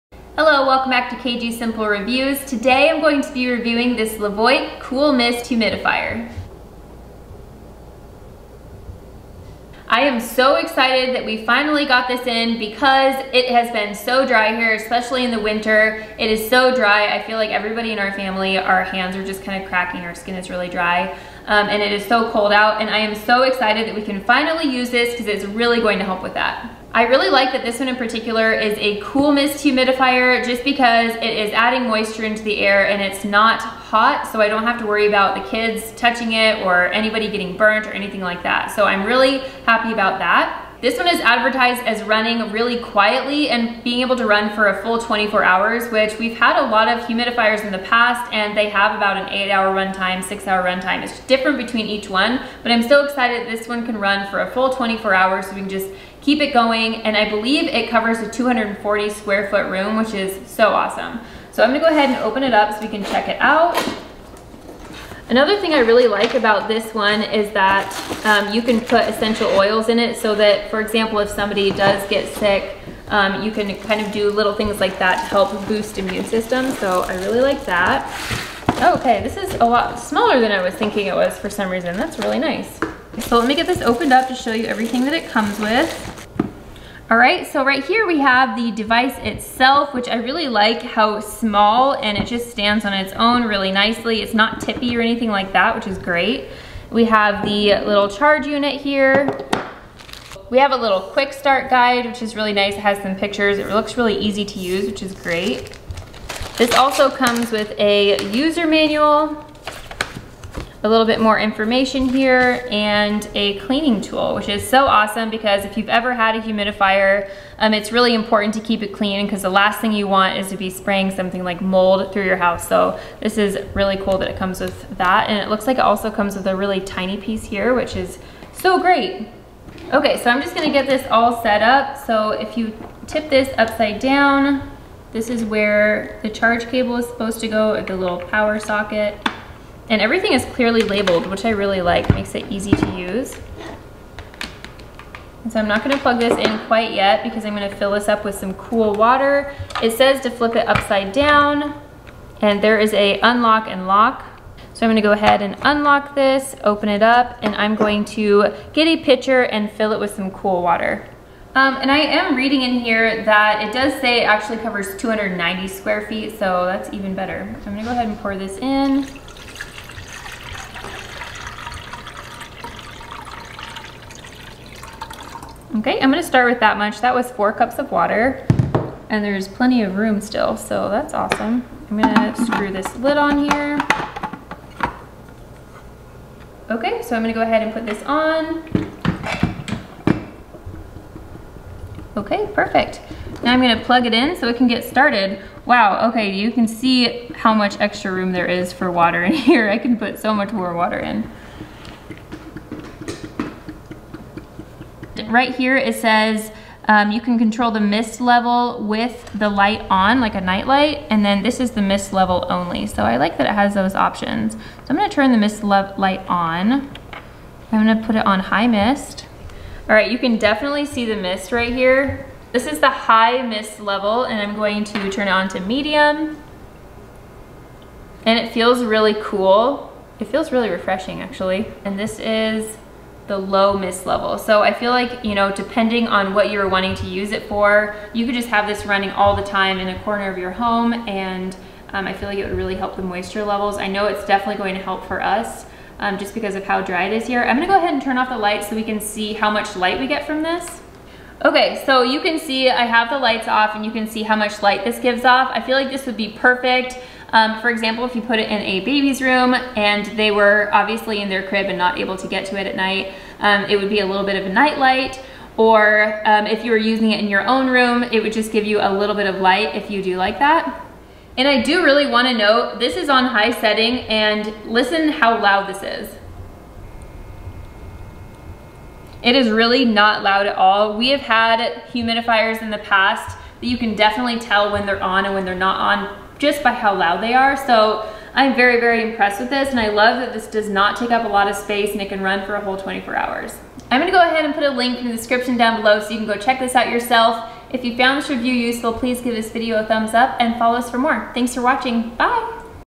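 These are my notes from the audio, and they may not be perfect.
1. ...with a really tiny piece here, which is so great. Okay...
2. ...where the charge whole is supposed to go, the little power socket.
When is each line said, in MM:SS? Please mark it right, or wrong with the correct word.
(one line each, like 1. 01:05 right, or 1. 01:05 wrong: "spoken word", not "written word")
1. 02:06 right
2. 02:15 wrong: "cable", not "whole".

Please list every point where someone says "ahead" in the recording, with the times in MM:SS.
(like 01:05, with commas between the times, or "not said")
01:01, 02:35, 02:47, 03:07, 04:07, 04:54.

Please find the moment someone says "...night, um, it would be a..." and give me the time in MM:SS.
04:22.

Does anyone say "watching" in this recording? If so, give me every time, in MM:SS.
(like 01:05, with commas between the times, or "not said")
05:01.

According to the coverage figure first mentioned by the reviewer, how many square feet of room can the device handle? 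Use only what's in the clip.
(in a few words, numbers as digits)
240 square feet.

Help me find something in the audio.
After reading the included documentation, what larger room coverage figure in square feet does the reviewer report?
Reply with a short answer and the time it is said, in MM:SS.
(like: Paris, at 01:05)
290 square feet, at 02:44.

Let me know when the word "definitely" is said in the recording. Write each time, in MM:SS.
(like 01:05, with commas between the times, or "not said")
03:40, 04:04, 04:43.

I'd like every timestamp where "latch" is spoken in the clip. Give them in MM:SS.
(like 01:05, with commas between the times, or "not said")
not said.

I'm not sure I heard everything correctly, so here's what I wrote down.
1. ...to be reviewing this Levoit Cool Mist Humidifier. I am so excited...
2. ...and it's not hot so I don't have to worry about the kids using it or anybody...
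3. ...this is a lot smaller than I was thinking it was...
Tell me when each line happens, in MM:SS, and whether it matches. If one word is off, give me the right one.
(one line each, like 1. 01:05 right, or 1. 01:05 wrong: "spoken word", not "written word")
1. 00:03 right
2. 00:32 wrong: "touching", not "using"
3. 01:19 right.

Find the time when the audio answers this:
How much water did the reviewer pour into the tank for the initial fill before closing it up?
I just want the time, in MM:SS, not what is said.
02:57.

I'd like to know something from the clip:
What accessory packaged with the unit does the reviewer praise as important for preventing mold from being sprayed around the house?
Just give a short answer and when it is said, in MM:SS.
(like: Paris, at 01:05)
cleaning tool, at 01:53.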